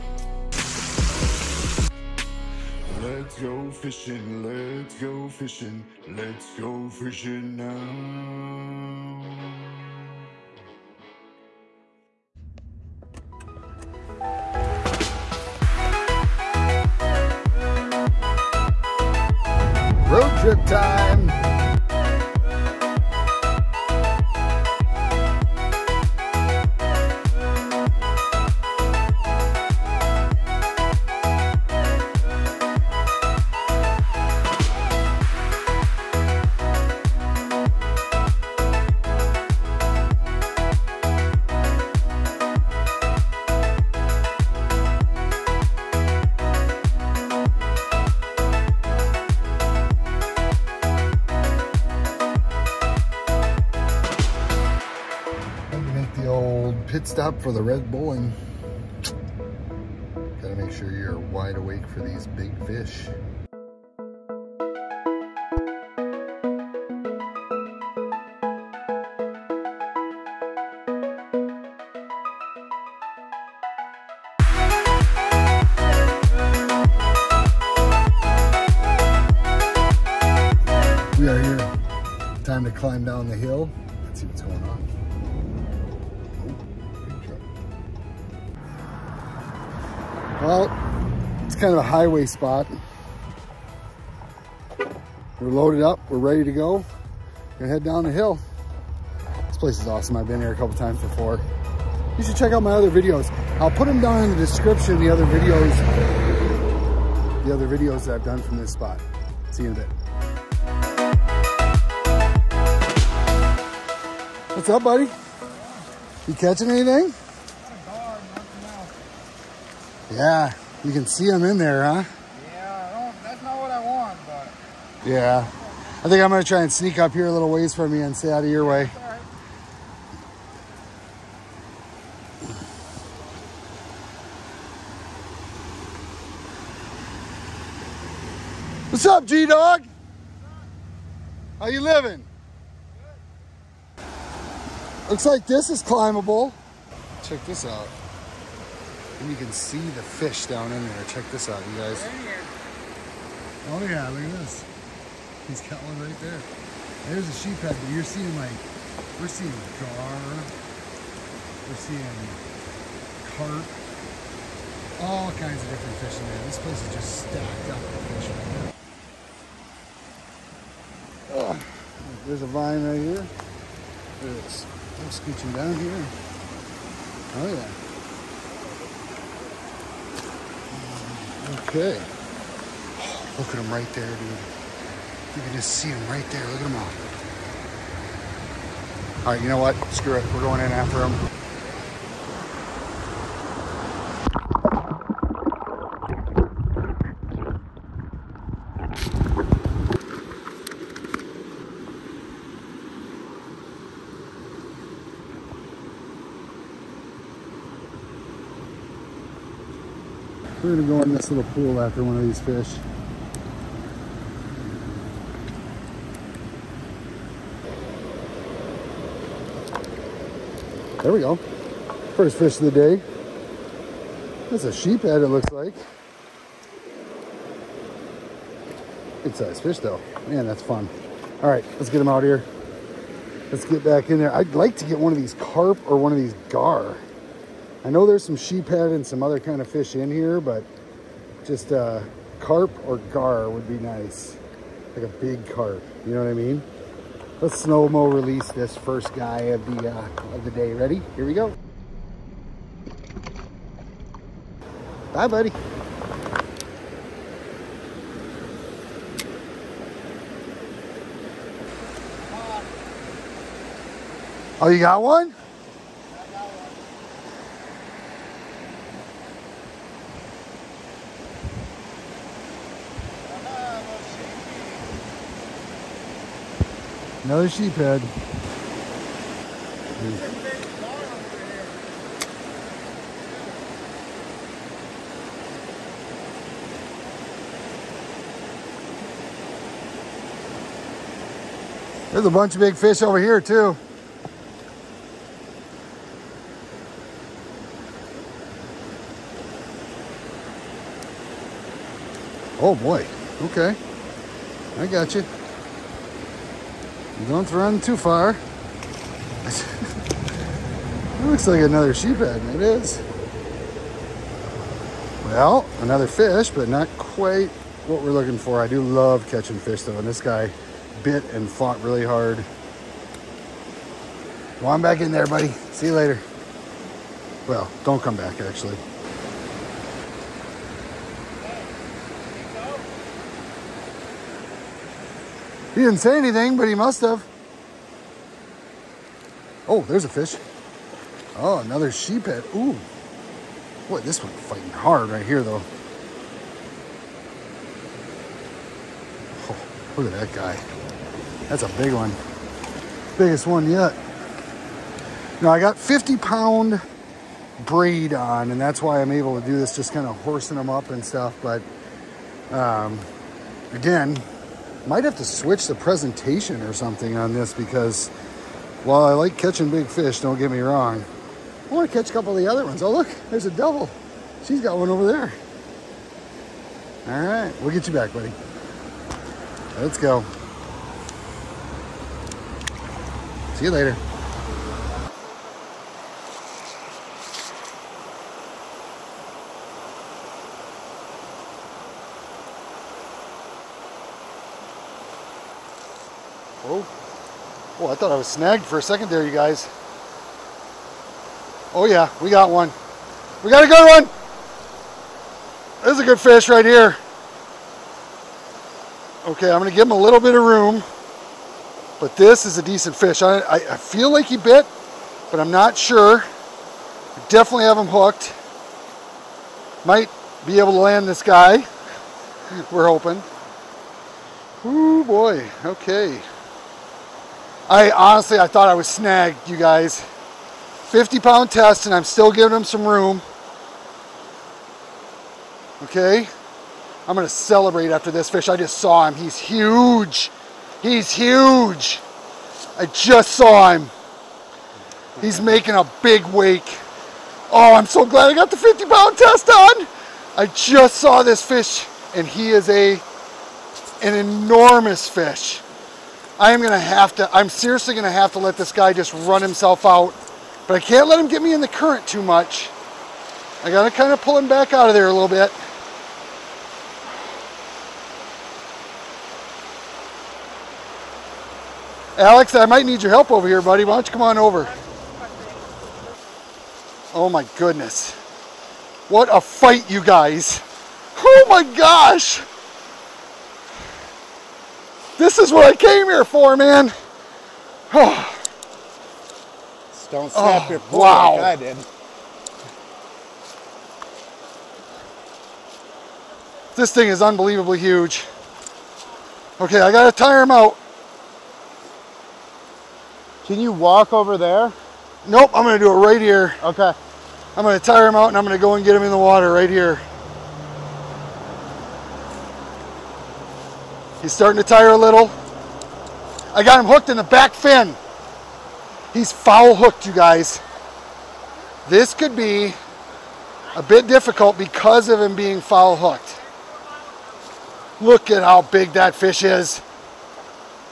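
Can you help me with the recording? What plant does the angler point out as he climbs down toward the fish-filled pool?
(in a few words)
a vine.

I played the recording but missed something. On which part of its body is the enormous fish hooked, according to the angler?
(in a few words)
back fin.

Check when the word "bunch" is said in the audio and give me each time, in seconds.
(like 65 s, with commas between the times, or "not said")
292 s.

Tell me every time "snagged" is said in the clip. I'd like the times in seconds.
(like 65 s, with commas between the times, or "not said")
398 s, 428 s.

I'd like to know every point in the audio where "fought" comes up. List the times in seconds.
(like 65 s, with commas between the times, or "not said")
321 s.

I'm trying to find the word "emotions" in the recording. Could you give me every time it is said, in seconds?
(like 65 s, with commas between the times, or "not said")
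not said.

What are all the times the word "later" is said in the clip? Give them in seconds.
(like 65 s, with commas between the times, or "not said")
325 s, 383 s.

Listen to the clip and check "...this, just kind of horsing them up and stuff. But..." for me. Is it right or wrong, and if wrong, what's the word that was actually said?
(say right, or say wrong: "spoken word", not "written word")
right.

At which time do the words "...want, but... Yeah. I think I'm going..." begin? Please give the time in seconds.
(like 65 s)
123 s.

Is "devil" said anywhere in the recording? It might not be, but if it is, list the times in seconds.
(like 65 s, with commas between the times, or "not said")
373 s.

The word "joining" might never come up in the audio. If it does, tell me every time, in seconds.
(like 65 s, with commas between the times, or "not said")
not said.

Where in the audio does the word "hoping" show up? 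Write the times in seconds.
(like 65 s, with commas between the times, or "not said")
422 s.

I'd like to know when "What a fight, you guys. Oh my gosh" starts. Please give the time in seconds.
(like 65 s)
479 s.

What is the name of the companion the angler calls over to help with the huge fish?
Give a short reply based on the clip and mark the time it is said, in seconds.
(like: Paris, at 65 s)
Alex, at 472 s.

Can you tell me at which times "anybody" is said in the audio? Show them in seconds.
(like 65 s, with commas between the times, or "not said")
not said.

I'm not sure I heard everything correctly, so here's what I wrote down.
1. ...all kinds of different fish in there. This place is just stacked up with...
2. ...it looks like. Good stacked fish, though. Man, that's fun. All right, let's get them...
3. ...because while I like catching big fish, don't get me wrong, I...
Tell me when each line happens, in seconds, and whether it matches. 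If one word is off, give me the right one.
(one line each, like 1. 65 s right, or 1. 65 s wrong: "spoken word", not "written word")
1. 165 s right
2. 225 s wrong: "sized", not "stacked"
3. 367 s right.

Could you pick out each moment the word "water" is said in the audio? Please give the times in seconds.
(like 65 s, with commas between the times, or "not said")
509 s.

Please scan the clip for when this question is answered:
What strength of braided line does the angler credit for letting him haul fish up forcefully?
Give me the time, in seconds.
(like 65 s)
355 s.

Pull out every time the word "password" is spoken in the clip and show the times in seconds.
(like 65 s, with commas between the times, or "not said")
not said.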